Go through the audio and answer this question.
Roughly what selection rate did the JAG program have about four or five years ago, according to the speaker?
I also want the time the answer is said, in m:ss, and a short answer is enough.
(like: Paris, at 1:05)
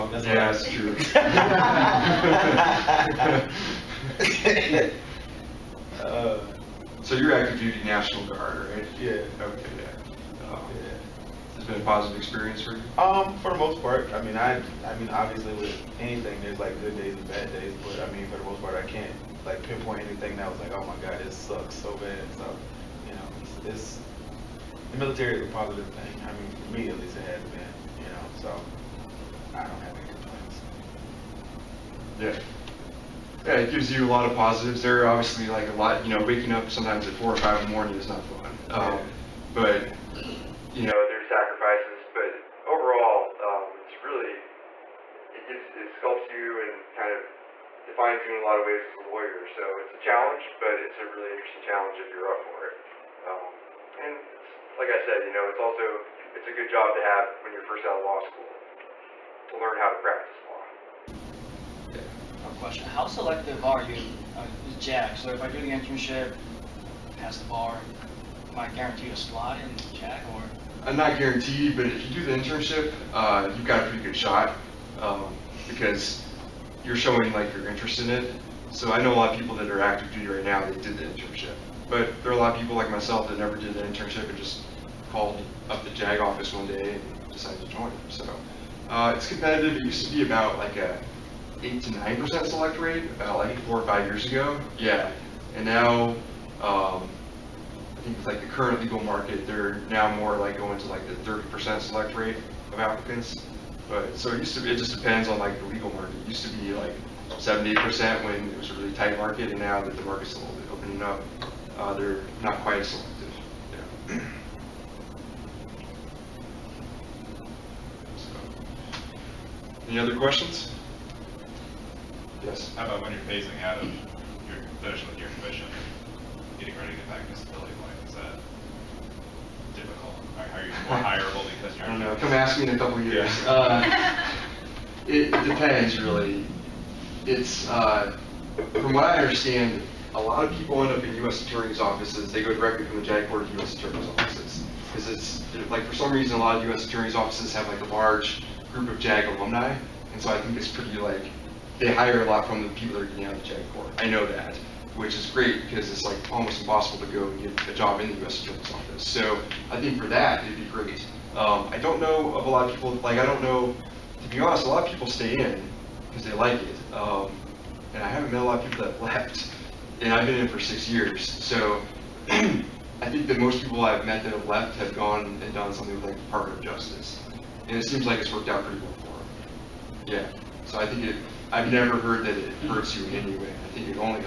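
8 to 9 percent, at 1:31.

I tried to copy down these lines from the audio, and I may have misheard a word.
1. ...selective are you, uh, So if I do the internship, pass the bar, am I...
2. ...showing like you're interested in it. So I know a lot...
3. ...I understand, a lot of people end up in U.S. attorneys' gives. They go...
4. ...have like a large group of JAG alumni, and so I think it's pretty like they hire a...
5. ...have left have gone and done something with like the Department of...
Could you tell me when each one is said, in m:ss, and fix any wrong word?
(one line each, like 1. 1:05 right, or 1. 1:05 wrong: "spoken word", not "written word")
1. 1:03 right
2. 1:16 right
3. 2:19 wrong: "offices", not "gives"
4. 2:27 right
5. 2:54 right.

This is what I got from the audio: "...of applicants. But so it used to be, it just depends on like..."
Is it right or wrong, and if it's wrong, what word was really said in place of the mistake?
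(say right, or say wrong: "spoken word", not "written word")
right.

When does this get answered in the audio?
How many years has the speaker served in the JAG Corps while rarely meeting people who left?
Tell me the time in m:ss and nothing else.
2:50.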